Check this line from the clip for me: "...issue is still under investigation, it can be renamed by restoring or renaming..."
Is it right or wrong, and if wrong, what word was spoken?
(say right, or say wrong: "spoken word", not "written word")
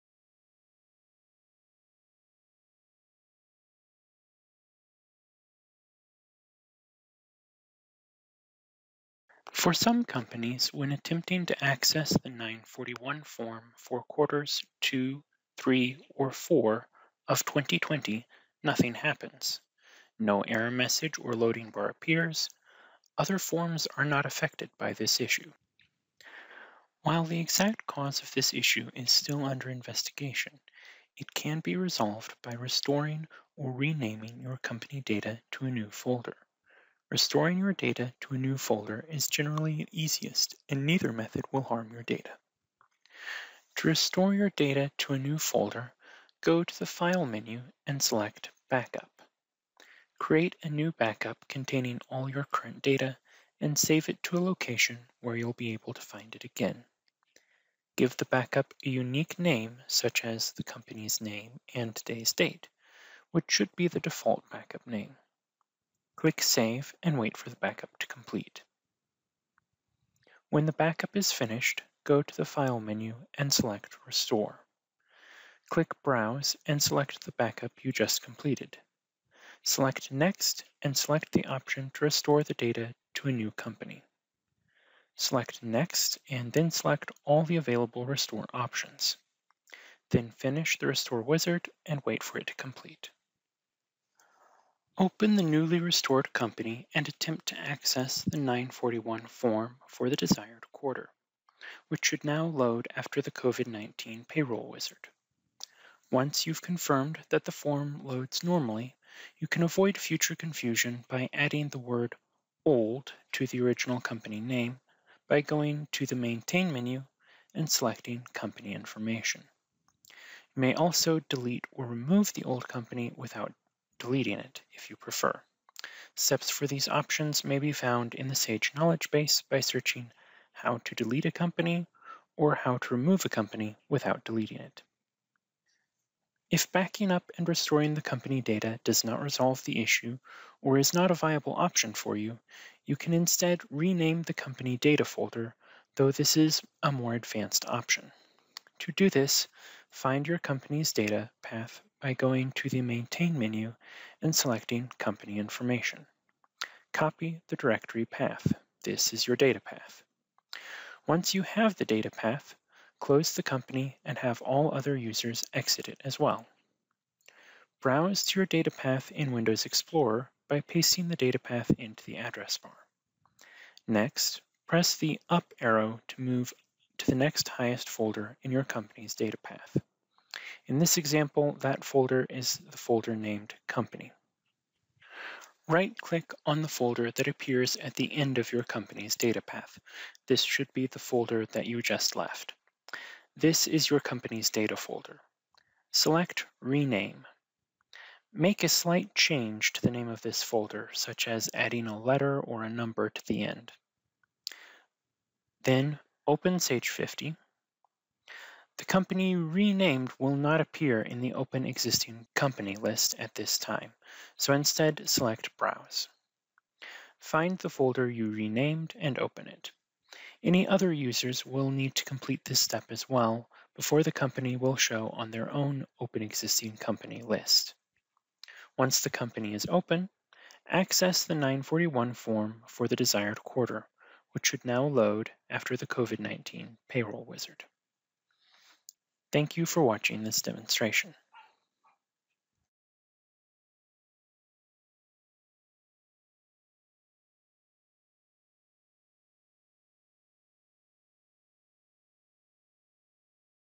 wrong: "resolved", not "renamed".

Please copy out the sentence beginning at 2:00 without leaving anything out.
You may also delete or remove the old company without deleting it if you prefer.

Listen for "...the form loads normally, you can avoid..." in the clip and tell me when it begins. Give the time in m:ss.
1:47.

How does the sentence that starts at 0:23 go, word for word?
Other forms are not affected by this issue.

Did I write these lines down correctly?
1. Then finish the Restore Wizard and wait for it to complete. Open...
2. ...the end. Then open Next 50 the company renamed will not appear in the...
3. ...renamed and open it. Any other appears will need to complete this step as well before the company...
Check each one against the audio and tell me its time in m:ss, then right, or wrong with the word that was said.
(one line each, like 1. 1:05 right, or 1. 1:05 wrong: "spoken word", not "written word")
1. 1:30 right
2. 3:23 wrong: "Sage", not "Next"
3. 3:38 wrong: "users", not "appears".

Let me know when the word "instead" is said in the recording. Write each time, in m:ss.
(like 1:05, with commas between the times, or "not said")
2:23, 3:34.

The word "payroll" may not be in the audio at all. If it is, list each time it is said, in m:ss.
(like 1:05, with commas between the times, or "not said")
1:44, 3:56.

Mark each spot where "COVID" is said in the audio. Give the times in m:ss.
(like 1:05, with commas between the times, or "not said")
1:43, 3:55.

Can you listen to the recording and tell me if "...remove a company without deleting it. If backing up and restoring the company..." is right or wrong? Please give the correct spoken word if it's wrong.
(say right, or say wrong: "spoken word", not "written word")
right.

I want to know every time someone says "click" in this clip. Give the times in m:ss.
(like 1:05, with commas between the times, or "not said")
1:06, 1:15, 3:05.